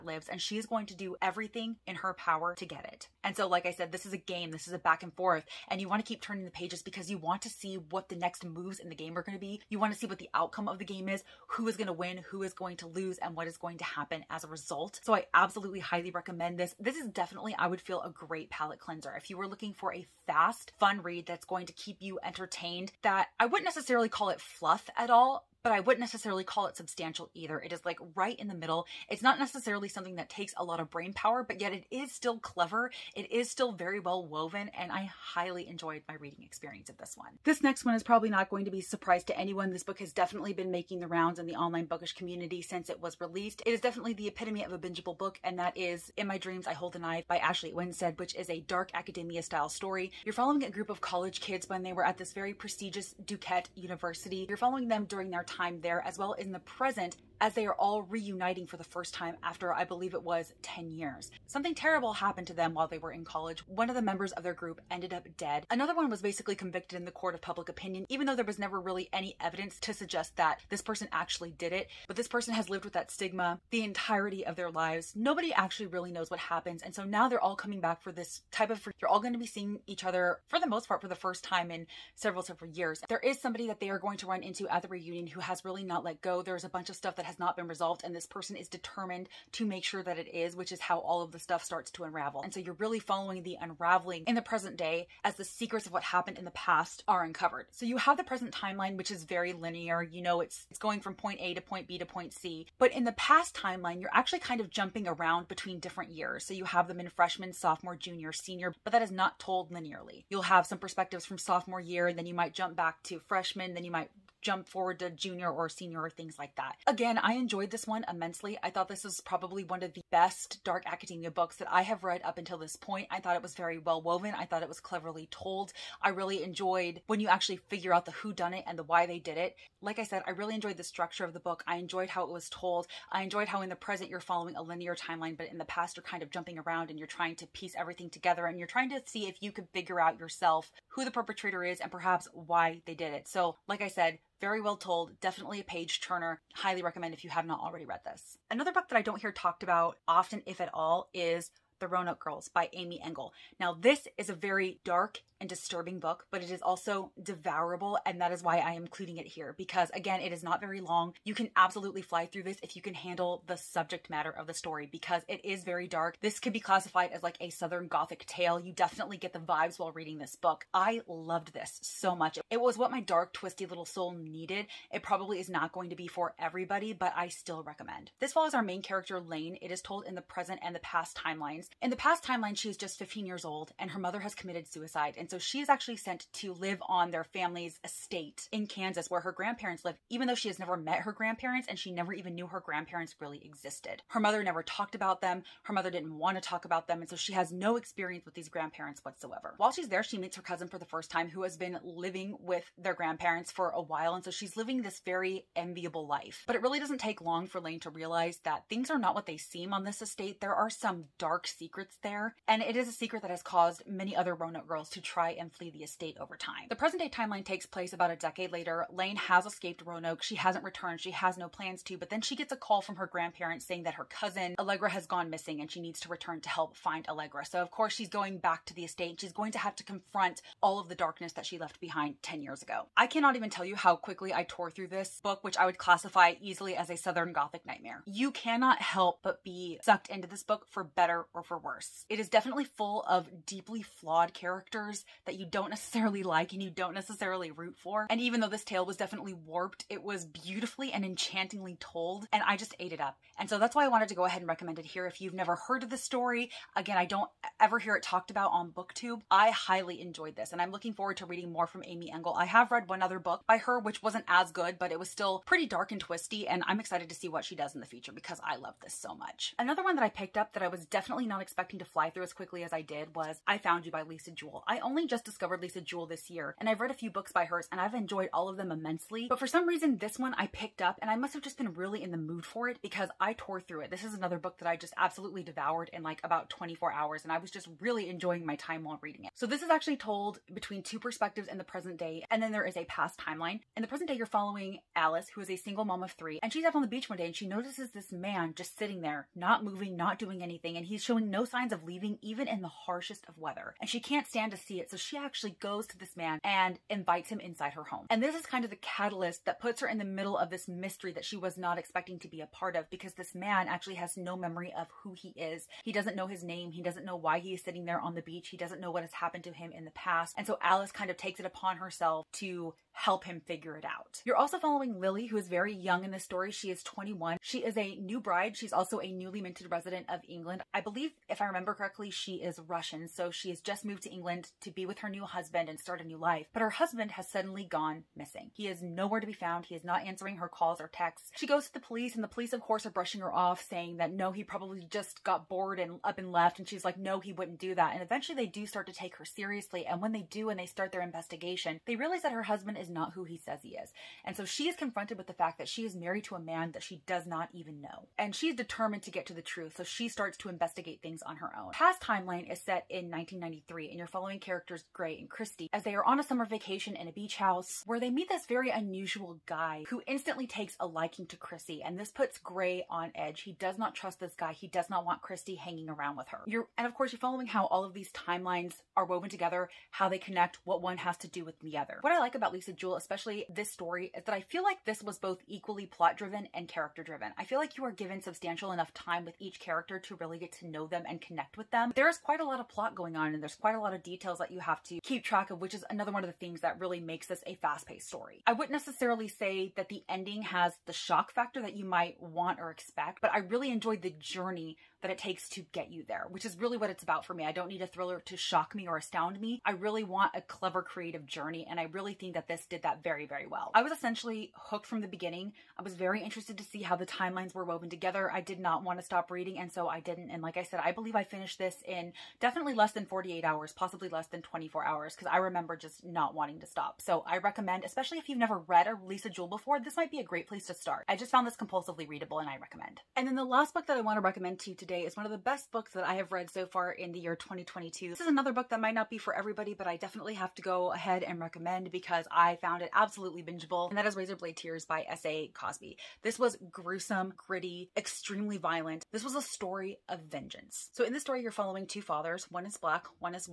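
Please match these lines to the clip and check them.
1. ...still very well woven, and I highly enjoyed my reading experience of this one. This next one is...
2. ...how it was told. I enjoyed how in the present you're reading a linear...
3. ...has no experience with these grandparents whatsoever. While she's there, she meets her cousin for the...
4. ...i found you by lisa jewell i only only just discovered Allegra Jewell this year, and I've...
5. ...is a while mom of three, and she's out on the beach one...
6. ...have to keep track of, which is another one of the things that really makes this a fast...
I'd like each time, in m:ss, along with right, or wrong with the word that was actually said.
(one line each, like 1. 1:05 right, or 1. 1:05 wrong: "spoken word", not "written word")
1. 0:33 right
2. 2:12 wrong: "following", not "reading"
3. 3:17 right
4. 4:33 wrong: "Lisa", not "Allegra"
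5. 4:55 wrong: "single", not "while"
6. 6:34 right.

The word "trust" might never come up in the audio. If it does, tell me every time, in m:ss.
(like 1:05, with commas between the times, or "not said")
6:13.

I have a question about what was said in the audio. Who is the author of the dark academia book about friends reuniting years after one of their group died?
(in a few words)
Ashley Winstead.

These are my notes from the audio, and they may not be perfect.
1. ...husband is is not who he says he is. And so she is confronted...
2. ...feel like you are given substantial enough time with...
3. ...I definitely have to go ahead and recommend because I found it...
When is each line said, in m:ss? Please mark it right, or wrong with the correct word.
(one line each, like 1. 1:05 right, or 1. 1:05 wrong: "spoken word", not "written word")
1. 5:52 right
2. 6:27 right
3. 7:19 right.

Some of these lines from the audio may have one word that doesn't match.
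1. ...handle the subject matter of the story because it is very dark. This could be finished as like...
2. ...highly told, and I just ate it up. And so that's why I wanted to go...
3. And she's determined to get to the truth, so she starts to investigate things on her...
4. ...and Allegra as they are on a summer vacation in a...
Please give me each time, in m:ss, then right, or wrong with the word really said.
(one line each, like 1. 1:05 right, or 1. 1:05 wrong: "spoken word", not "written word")
1. 2:42 wrong: "classified", not "finished"
2. 4:11 wrong: "enchantingly", not "highly"
3. 5:58 right
4. 6:05 wrong: "Christy", not "Allegra".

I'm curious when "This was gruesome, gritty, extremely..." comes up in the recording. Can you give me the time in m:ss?
7:26.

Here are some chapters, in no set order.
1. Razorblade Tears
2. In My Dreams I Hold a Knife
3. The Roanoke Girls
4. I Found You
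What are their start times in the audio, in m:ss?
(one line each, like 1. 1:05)
1. 7:14
2. 0:36
3. 2:28
4. 4:29.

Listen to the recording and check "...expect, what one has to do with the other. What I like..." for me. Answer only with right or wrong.
wrong.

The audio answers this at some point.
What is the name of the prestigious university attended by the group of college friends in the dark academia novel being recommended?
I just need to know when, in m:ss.
0:53.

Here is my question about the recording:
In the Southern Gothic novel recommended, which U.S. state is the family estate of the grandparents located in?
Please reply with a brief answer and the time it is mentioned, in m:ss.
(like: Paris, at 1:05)
Kansas, at 3:08.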